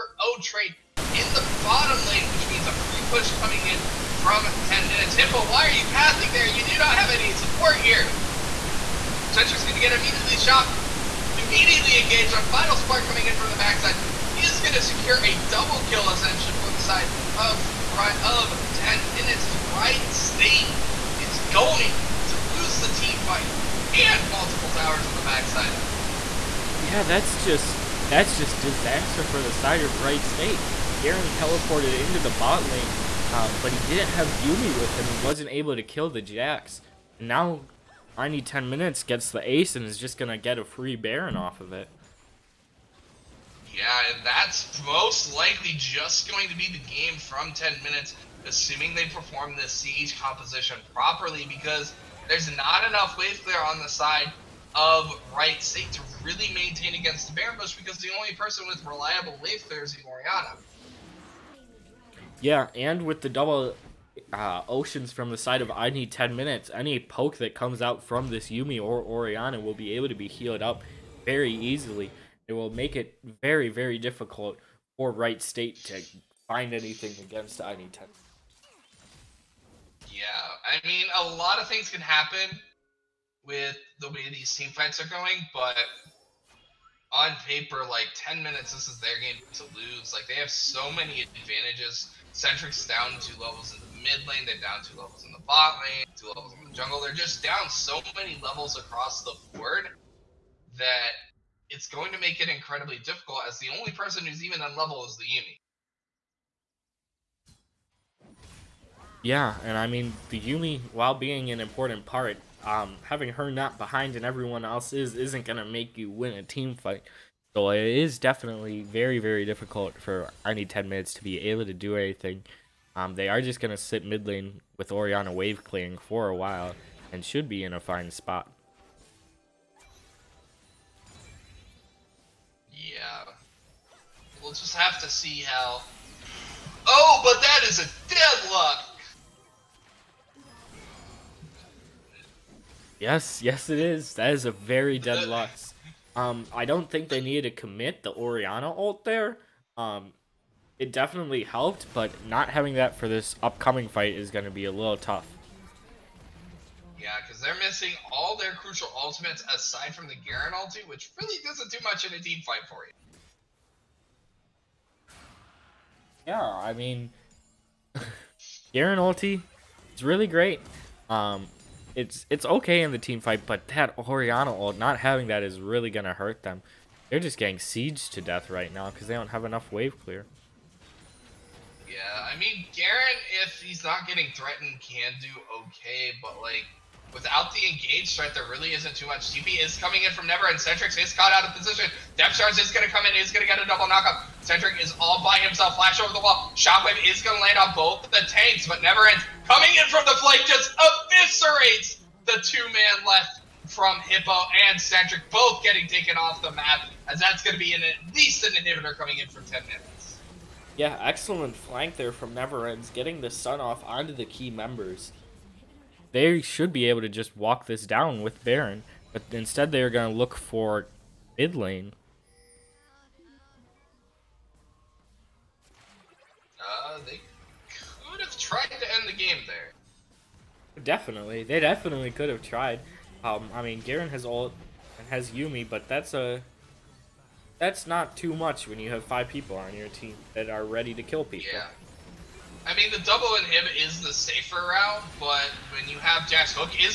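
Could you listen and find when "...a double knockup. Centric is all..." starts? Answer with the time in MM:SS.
03:13.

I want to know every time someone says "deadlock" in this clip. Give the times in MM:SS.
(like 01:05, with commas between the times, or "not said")
02:18, 02:24.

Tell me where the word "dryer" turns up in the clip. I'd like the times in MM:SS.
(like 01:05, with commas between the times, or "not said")
not said.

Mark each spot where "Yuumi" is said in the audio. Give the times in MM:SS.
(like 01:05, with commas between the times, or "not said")
00:34, 01:08, 01:45, 01:50, 03:55.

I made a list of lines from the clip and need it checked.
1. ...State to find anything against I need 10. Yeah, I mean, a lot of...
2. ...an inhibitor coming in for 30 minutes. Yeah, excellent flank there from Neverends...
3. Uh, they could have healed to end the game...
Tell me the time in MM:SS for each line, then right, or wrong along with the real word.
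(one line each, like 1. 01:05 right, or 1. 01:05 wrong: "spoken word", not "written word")
1. 01:15 right
2. 03:28 wrong: "10", not "30"
3. 03:46 wrong: "tried", not "healed".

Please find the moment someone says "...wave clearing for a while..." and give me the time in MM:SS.
02:05.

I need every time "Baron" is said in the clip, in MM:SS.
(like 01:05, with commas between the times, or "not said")
00:40, 00:57, 03:38.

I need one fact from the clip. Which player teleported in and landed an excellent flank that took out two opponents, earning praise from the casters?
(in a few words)
Neverends.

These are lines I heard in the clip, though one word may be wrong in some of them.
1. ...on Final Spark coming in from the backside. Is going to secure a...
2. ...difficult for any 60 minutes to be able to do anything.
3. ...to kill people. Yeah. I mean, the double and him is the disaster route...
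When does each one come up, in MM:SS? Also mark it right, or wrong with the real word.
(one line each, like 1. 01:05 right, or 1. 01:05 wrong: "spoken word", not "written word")
1. 00:12 right
2. 01:59 wrong: "10", not "60"
3. 04:00 wrong: "safer", not "disaster".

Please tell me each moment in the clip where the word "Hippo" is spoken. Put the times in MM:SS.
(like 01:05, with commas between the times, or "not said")
00:05, 03:24.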